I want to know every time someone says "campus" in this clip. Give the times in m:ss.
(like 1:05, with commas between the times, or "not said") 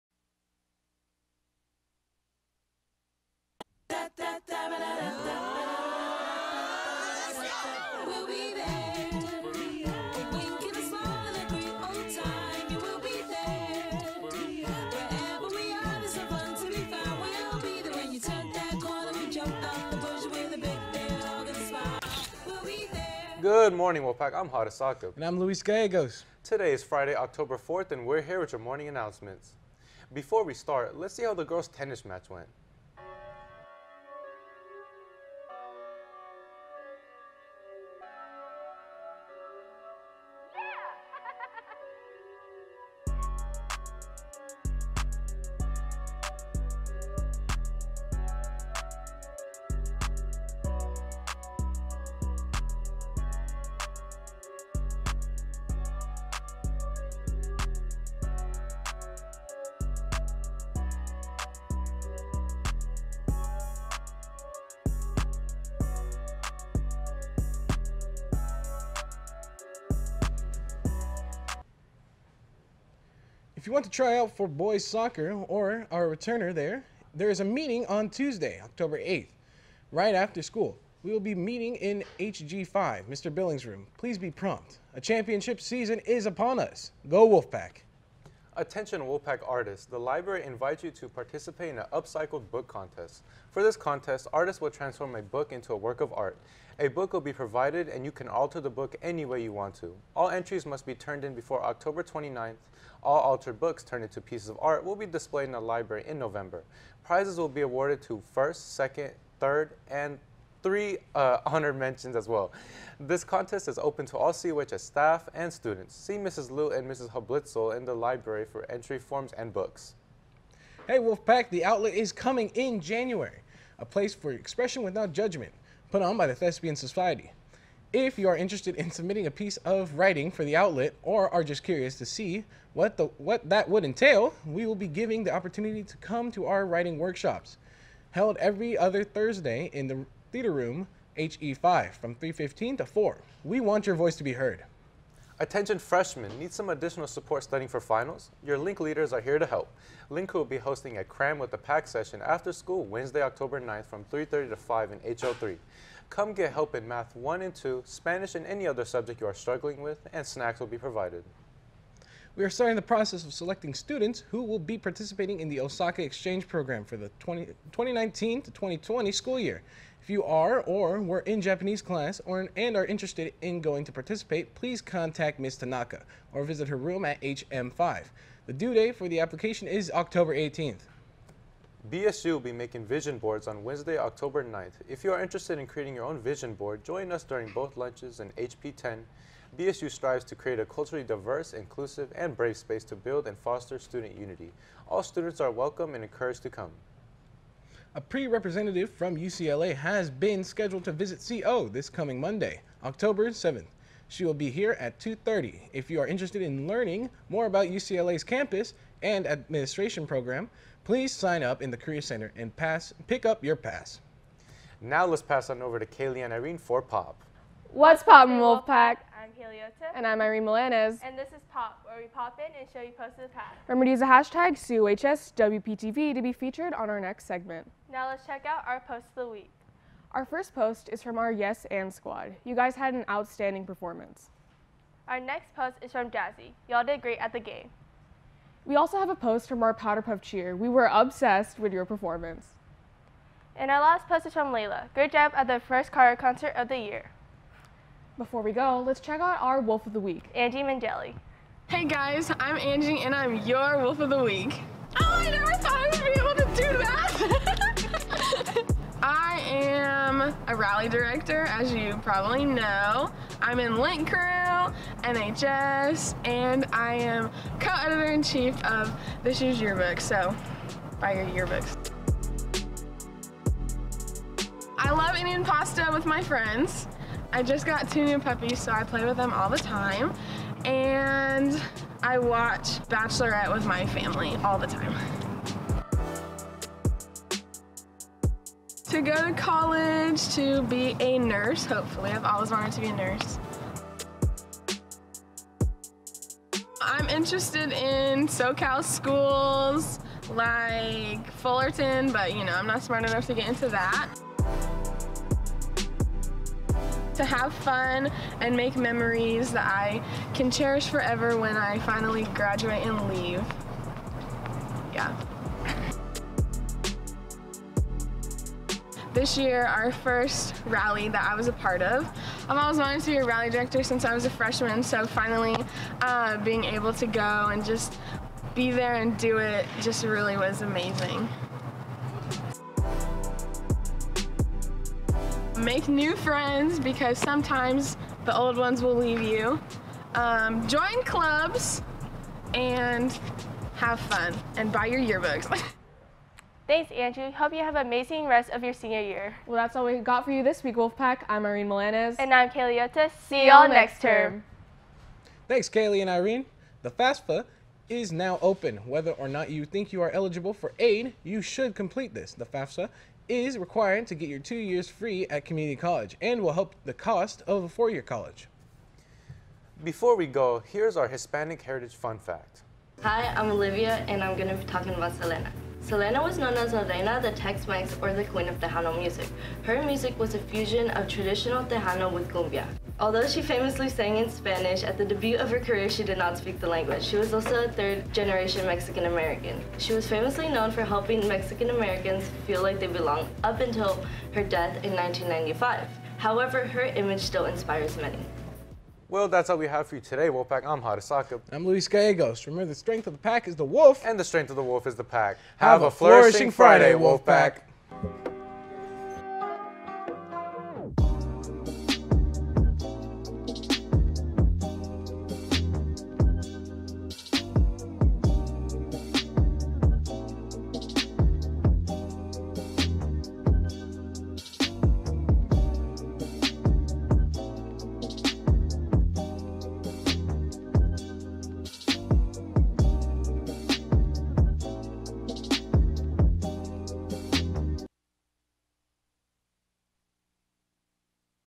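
3:28.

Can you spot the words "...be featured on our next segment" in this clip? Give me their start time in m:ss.
3:46.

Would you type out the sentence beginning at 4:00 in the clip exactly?
We were obsessed with your performance.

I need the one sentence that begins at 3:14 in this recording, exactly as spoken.
All students are welcome and encouraged to come.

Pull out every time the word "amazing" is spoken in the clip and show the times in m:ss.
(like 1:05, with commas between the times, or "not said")
5:30, 5:47.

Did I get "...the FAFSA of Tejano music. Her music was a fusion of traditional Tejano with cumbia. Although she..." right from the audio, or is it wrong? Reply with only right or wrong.
wrong.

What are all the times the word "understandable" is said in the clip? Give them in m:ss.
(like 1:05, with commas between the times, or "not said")
not said.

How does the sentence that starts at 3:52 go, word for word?
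You guys had an outstanding performance.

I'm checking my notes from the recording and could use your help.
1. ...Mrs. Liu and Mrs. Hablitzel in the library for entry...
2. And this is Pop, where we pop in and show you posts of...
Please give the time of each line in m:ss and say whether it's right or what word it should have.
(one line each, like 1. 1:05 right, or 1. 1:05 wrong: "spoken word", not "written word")
1. 1:56 right
2. 3:41 right.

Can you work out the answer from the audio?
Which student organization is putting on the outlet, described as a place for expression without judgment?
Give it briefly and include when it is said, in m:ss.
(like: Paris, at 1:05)
Thespian Society, at 2:06.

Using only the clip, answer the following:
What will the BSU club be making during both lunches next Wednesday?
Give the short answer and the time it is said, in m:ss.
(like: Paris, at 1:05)
Vision boards, at 3:02.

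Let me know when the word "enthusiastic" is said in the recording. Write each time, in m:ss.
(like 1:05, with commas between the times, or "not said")
not said.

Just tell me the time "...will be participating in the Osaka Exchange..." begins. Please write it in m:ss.
2:44.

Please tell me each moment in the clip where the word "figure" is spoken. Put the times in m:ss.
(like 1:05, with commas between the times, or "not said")
not said.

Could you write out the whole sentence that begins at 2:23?
We want your voice to be heard.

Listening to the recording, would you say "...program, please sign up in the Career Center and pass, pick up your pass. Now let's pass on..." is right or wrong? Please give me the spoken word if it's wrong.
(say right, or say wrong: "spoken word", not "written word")
right.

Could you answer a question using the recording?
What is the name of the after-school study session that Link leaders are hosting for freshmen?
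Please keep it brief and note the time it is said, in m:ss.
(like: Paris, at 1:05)
Cram with the Pack, at 2:31.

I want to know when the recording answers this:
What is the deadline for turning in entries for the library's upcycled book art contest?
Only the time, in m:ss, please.
1:41.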